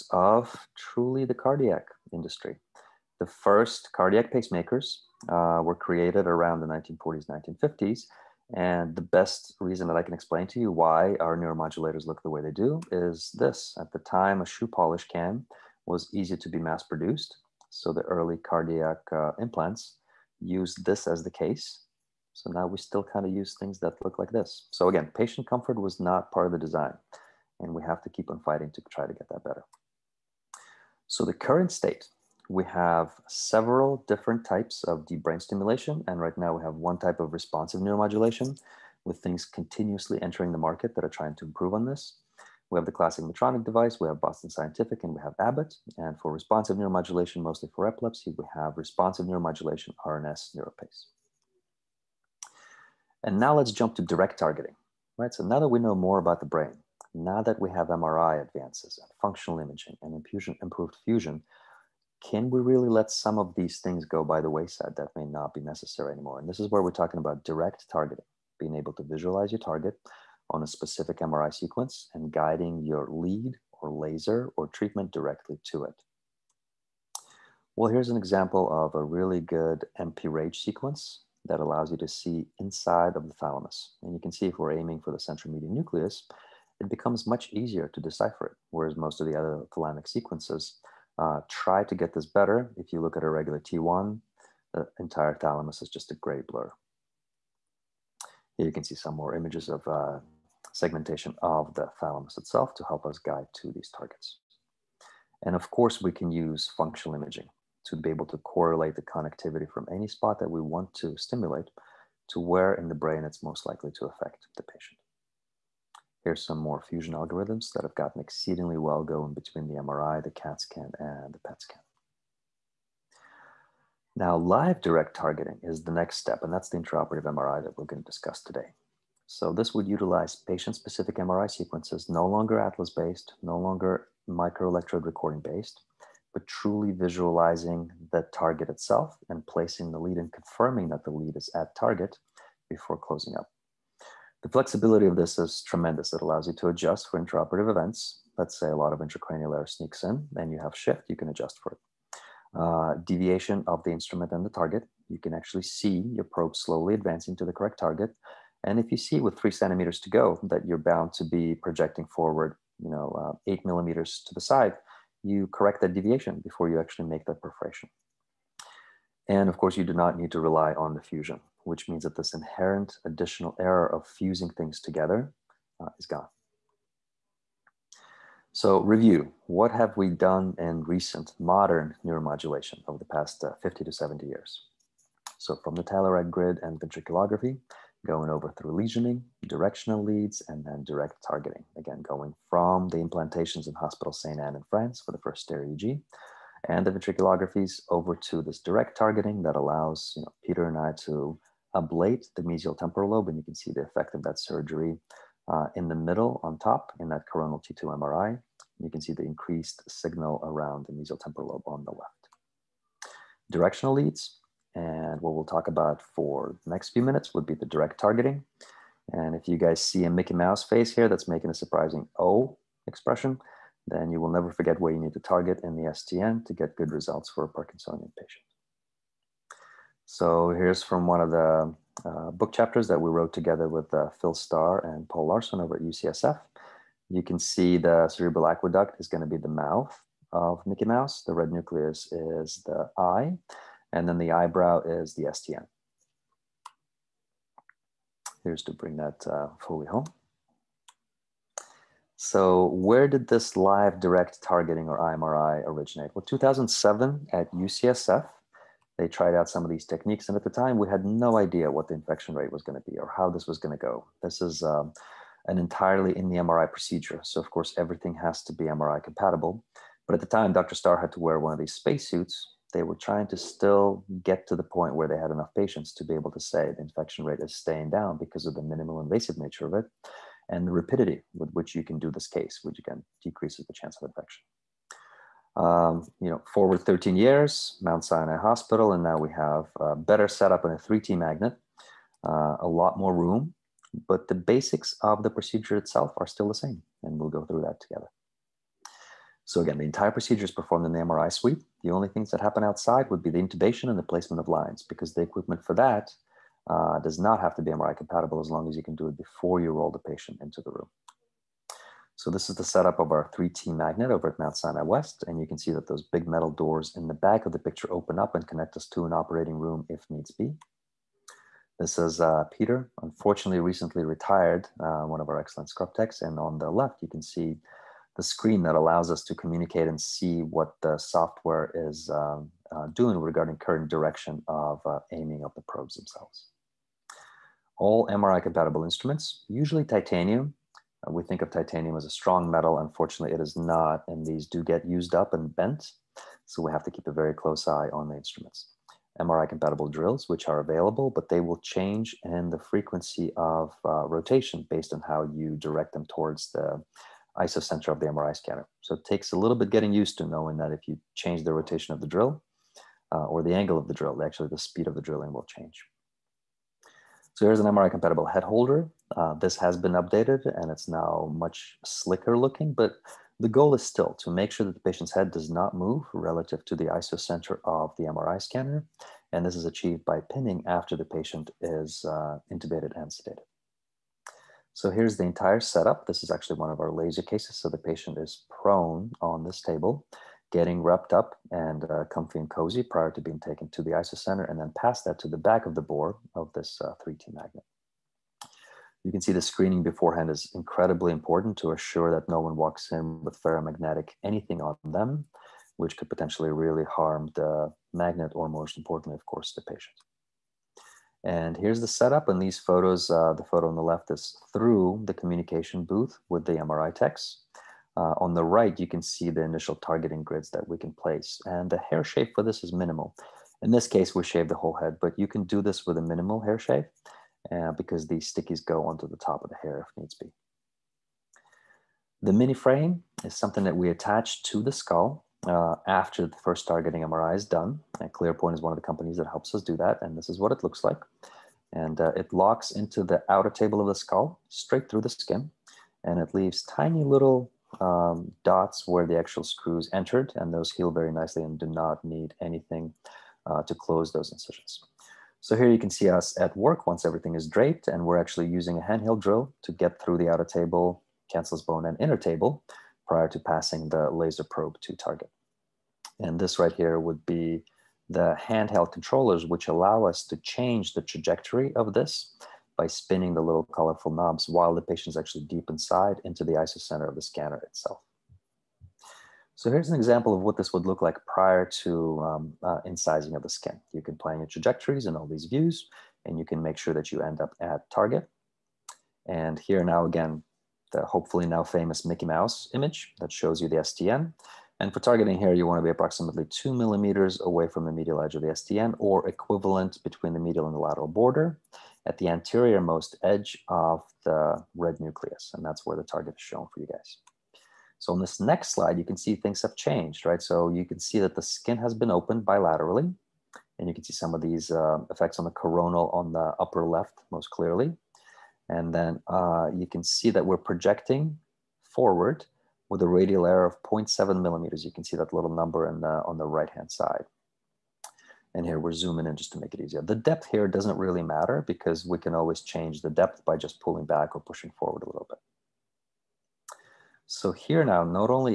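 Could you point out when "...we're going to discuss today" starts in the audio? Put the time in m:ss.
2:07.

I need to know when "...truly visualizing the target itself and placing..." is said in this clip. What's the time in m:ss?
2:16.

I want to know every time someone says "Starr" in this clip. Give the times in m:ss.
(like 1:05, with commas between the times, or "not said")
3:54, 4:30.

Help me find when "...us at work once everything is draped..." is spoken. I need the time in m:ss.
7:36.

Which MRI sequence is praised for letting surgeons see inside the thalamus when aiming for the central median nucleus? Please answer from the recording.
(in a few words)
MP-RAGE.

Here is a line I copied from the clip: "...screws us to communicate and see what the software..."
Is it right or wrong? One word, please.
wrong.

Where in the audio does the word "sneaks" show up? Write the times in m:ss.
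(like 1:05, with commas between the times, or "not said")
2:29.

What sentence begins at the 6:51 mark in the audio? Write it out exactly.
And here's the setup in these photos.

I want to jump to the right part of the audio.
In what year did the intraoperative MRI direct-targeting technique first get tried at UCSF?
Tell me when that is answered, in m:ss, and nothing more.
4:16.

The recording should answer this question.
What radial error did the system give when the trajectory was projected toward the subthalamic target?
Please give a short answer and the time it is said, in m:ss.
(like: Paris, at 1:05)
0.7 millimeters, at 8:43.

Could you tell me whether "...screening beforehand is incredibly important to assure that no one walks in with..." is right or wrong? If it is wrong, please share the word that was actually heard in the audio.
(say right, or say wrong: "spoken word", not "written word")
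right.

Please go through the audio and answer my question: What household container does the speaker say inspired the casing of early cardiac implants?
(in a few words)
shoe polish can.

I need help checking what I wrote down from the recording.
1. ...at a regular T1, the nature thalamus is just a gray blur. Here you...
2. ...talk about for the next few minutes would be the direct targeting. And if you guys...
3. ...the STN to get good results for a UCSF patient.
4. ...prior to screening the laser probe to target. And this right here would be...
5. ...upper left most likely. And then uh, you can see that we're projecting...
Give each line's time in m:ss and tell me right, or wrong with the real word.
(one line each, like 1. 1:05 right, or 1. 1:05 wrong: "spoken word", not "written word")
1. 1:33 wrong: "entire", not "nature"
2. 3:35 right
3. 3:45 wrong: "Parkinsonian", not "UCSF"
4. 7:43 wrong: "passing", not "screening"
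5. 8:36 wrong: "clearly", not "likely".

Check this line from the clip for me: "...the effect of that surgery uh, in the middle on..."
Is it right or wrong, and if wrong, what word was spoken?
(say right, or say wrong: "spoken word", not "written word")
right.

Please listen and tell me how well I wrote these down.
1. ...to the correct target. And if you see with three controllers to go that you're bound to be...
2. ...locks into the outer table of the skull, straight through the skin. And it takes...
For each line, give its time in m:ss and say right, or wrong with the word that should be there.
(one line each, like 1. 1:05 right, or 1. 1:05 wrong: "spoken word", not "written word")
1. 2:37 wrong: "centimeters", not "controllers"
2. 7:22 wrong: "leaves", not "takes".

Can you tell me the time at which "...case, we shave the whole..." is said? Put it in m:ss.
7:03.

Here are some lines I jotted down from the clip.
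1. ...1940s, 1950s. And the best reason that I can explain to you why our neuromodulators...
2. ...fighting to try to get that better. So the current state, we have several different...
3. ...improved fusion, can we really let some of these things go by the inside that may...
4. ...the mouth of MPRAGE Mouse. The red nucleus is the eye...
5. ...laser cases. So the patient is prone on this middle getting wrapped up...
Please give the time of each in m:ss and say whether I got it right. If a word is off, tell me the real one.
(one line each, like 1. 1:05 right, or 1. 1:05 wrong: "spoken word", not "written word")
1. 0:06 right
2. 0:28 right
3. 1:00 wrong: "wayside", not "inside"
4. 3:59 wrong: "Mickey", not "MPRAGE"
5. 6:26 wrong: "table", not "middle".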